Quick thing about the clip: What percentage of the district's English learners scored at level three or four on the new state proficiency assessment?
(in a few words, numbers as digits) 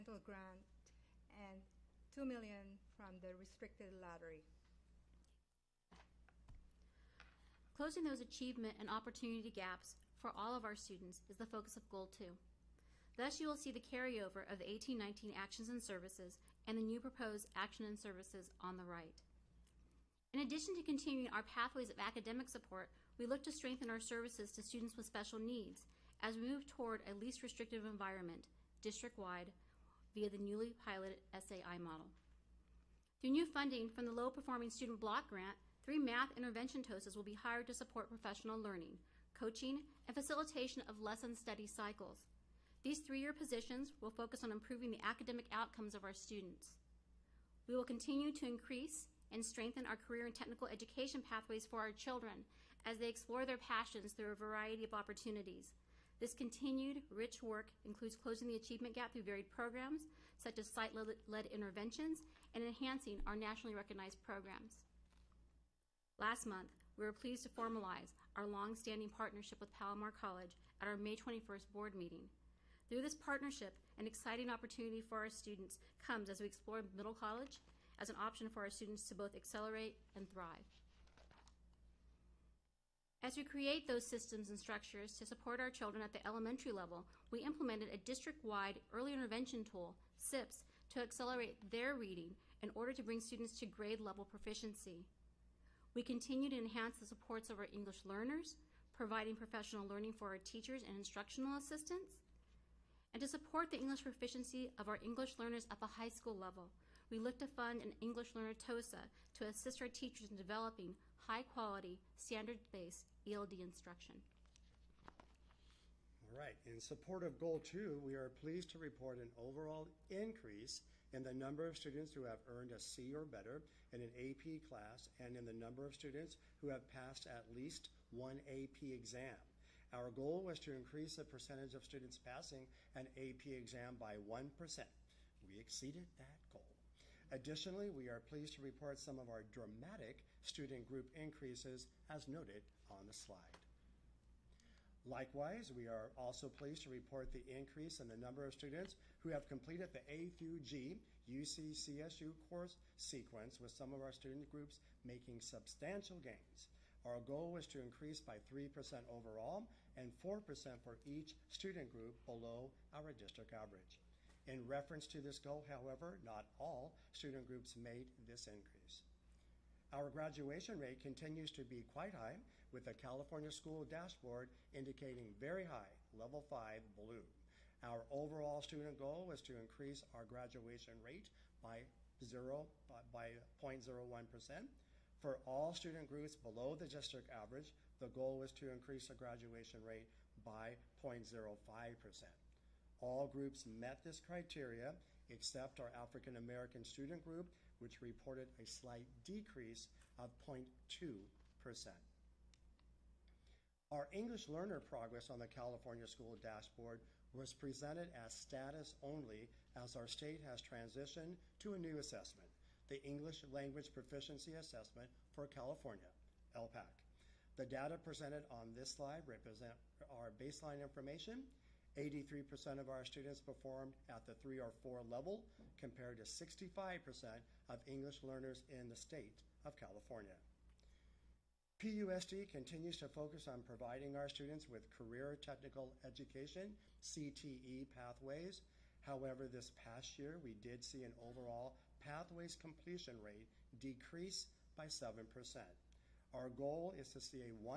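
83%.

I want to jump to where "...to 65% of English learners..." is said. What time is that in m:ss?
3:46.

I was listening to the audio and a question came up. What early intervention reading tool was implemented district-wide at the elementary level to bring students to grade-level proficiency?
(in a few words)
SIPPS.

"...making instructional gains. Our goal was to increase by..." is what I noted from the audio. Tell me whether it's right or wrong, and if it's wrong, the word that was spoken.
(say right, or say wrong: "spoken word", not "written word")
wrong: "substantial", not "instructional".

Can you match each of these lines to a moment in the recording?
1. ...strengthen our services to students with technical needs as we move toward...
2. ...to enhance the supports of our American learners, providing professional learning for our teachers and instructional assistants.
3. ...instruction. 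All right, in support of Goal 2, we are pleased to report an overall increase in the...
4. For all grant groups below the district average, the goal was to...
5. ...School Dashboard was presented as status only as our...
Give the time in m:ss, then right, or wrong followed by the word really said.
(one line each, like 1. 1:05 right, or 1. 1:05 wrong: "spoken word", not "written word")
1. 0:23 wrong: "special", not "technical"
2. 1:36 wrong: "English", not "American"
3. 1:53 right
4. 3:05 wrong: "student", not "grant"
5. 3:26 right.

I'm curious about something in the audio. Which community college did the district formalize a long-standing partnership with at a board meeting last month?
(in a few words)
Palomar College.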